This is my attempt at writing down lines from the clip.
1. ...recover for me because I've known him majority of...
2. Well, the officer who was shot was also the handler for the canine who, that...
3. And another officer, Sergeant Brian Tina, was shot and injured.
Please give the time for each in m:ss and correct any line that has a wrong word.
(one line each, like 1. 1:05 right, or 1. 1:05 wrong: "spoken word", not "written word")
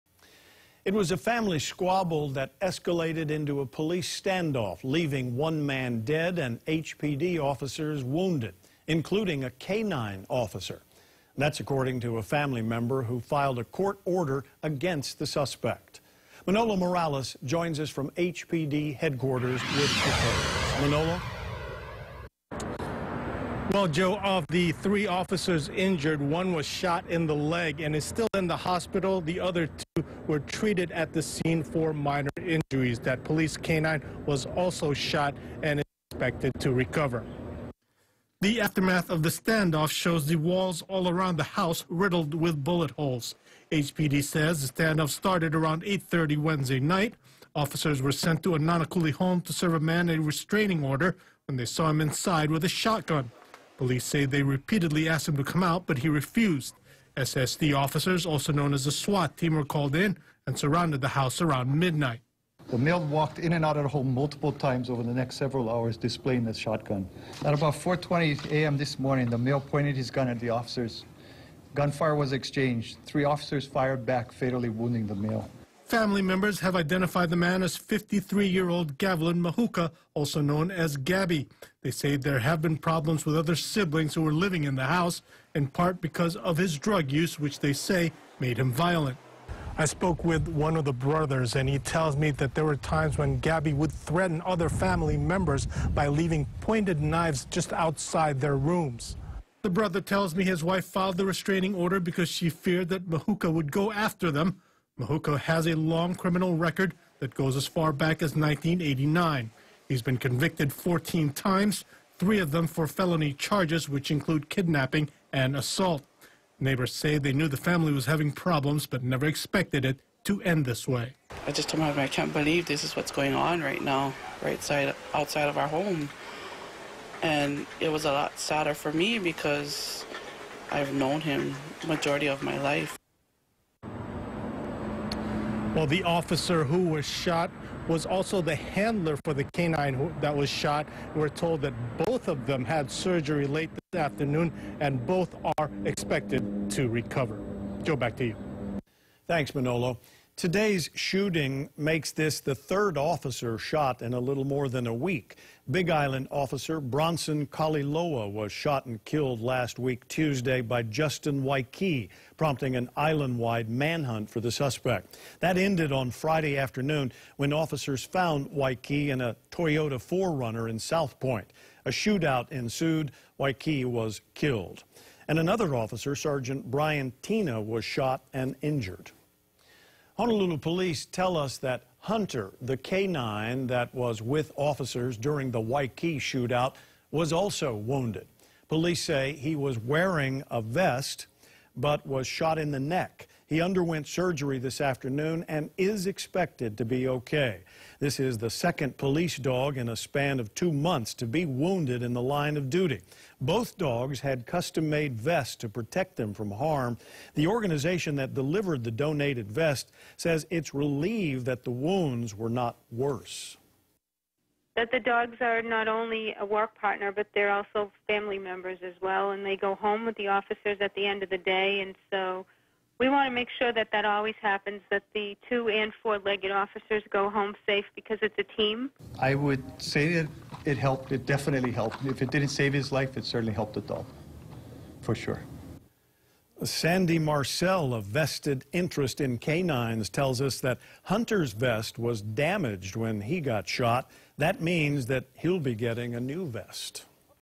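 1. 2:08 wrong: "sadder", not "recover"
2. 2:15 right
3. 2:55 right.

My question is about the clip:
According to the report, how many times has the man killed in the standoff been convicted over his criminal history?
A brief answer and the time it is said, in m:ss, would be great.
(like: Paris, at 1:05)
14, at 1:50.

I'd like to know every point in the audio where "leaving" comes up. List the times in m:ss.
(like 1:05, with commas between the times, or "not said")
0:04, 1:36.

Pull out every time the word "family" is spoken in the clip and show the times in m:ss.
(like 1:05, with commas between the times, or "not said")
0:01, 0:12, 1:15, 1:34, 1:57, 3:38.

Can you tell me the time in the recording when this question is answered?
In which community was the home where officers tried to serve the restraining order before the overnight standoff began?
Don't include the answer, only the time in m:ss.
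0:48.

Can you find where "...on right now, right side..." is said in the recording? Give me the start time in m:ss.
2:03.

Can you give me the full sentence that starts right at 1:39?
The brother tells me his wife filed the restraining order because she feared that Mahuka would go after them.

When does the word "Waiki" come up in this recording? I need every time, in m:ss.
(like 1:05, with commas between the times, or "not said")
2:41, 2:48, 2:53, 3:05.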